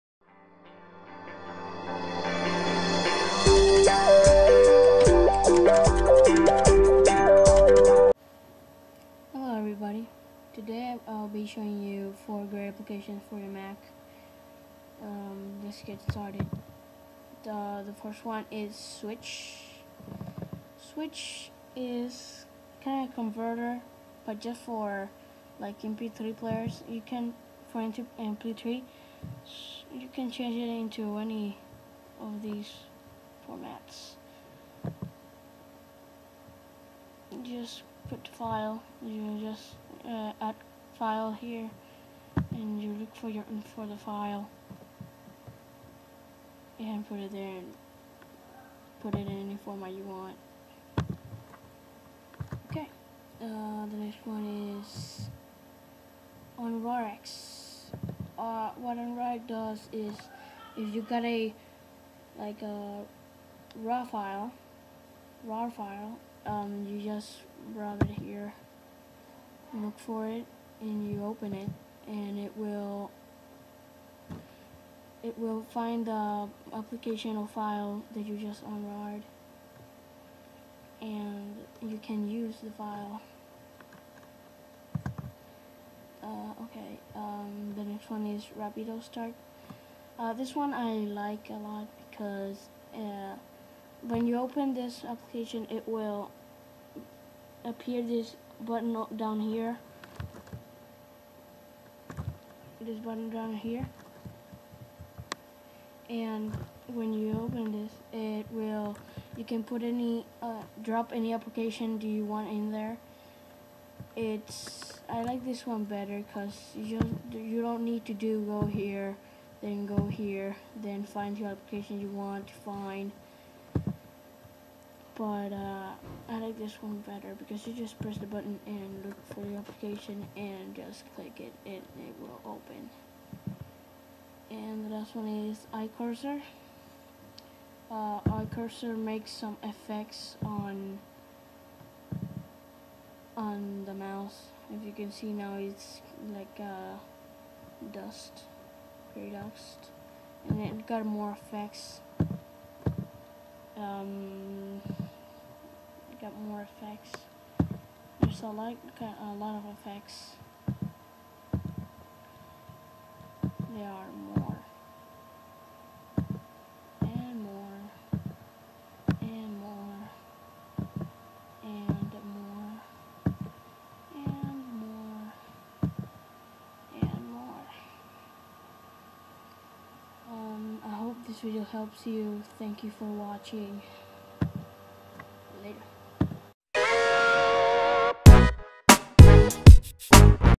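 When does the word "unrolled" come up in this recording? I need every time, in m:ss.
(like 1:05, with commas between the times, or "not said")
1:18.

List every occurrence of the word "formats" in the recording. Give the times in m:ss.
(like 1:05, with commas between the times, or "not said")
0:33, 0:49.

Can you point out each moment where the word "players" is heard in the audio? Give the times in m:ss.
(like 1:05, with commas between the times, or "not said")
0:26.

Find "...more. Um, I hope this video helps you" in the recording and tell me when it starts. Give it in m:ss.
2:57.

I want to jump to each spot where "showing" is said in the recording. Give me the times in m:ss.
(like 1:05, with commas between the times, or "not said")
0:11.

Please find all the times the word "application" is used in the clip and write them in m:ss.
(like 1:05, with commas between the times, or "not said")
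0:12, 1:16, 1:35, 1:51, 2:01, 2:09.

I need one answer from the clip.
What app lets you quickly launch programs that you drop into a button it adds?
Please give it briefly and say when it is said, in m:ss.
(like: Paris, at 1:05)
Rapido Start, at 1:28.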